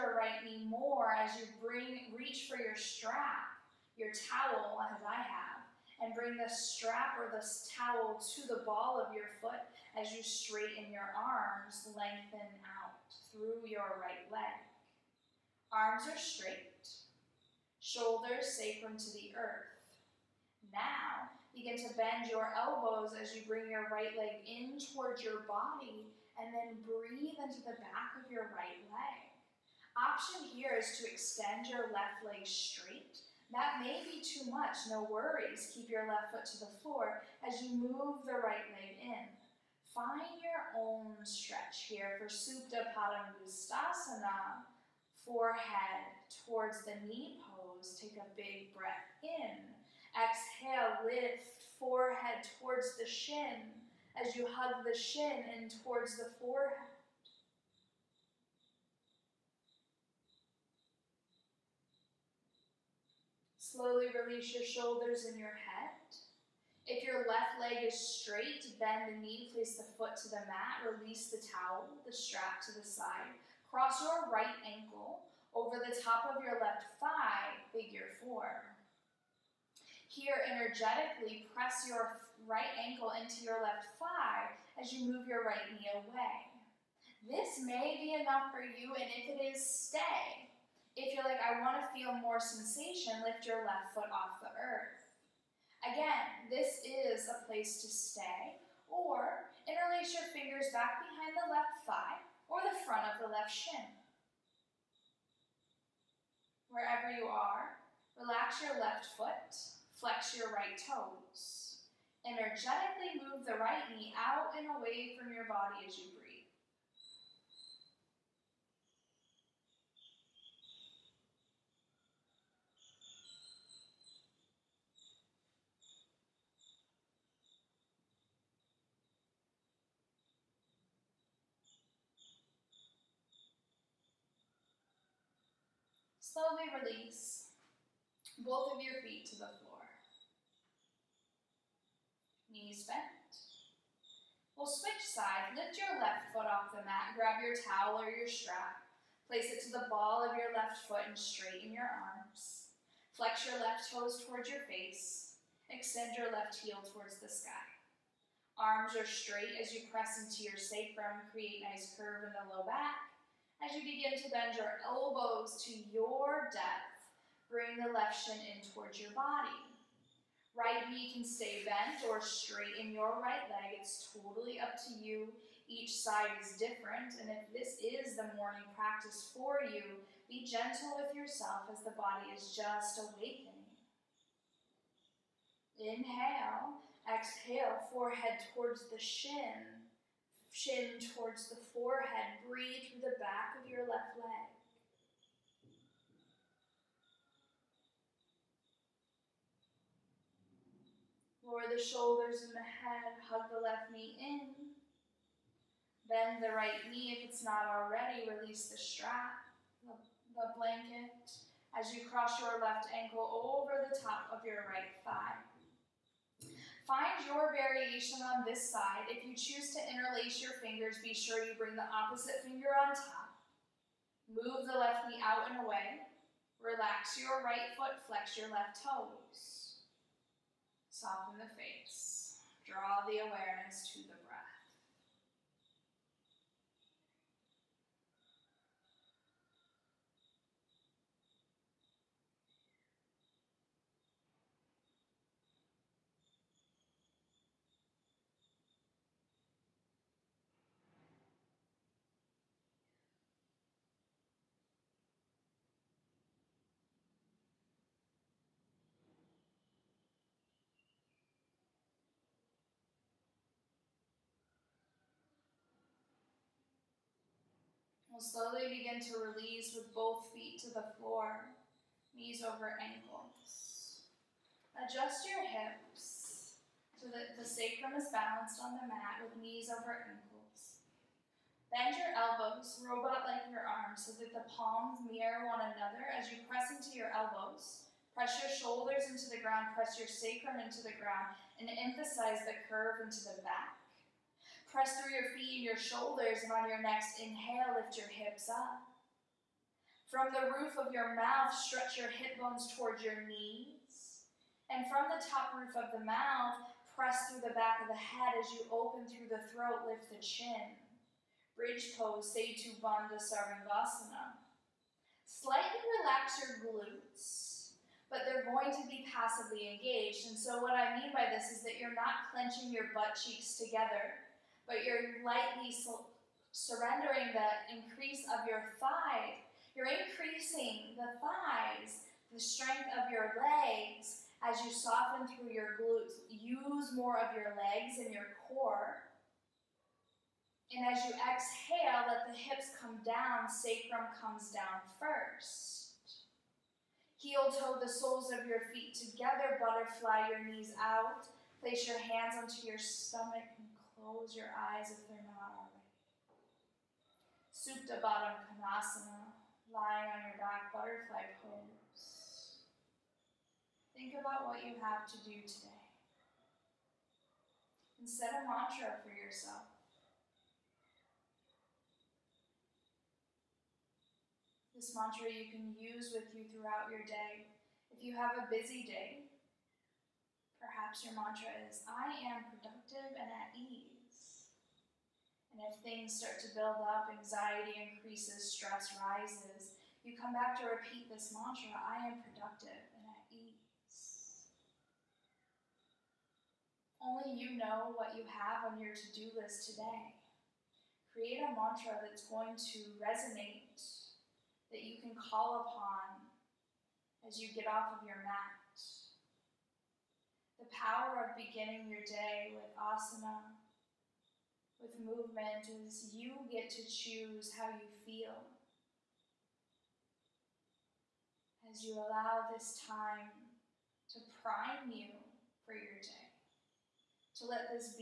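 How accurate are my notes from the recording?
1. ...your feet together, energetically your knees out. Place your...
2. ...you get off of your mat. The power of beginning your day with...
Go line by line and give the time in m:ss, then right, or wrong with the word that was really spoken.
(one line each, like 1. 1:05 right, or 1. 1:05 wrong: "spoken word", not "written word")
1. 5:48 wrong: "butterfly", not "energetically"
2. 6:47 right.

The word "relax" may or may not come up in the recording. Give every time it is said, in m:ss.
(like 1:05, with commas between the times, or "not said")
1:48, 3:46, 5:15.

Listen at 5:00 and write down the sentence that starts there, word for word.
From the roof of your mouth, stretch your hip bones towards your knees.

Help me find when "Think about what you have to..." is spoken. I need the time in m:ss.
6:03.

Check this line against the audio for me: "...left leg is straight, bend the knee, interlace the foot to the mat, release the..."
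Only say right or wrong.
wrong.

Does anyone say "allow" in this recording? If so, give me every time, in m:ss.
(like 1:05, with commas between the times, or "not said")
7:01.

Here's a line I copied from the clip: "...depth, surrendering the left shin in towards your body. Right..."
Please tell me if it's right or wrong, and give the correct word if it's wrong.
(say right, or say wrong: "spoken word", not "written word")
wrong: "bring", not "surrendering".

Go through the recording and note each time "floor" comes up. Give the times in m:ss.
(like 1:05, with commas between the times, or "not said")
0:36, 2:19, 4:30.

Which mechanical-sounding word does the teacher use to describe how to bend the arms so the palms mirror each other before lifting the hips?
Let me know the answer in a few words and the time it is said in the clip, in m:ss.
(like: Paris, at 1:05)
robot, at 4:42.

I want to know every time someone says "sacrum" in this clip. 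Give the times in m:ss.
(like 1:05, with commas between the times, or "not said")
0:18, 2:40, 4:37, 4:50, 5:43.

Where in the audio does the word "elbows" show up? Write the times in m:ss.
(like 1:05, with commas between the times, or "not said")
0:22, 2:44, 4:42, 4:47.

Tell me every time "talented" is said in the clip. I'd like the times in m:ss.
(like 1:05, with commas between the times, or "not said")
not said.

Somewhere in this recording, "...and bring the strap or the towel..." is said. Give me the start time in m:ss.
0:06.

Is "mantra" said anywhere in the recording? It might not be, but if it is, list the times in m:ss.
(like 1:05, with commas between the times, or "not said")
6:08, 6:14, 6:21, 6:31, 6:41.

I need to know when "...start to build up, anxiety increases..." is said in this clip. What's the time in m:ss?
6:26.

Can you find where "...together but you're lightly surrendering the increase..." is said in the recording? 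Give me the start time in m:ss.
5:23.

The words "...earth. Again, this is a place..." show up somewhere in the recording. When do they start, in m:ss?
1:34.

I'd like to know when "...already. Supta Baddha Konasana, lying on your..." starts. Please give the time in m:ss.
5:55.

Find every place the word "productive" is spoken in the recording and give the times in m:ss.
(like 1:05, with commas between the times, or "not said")
6:22, 6:32.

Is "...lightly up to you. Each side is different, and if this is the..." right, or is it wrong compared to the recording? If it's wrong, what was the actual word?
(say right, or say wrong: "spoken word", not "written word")
wrong: "totally", not "lightly".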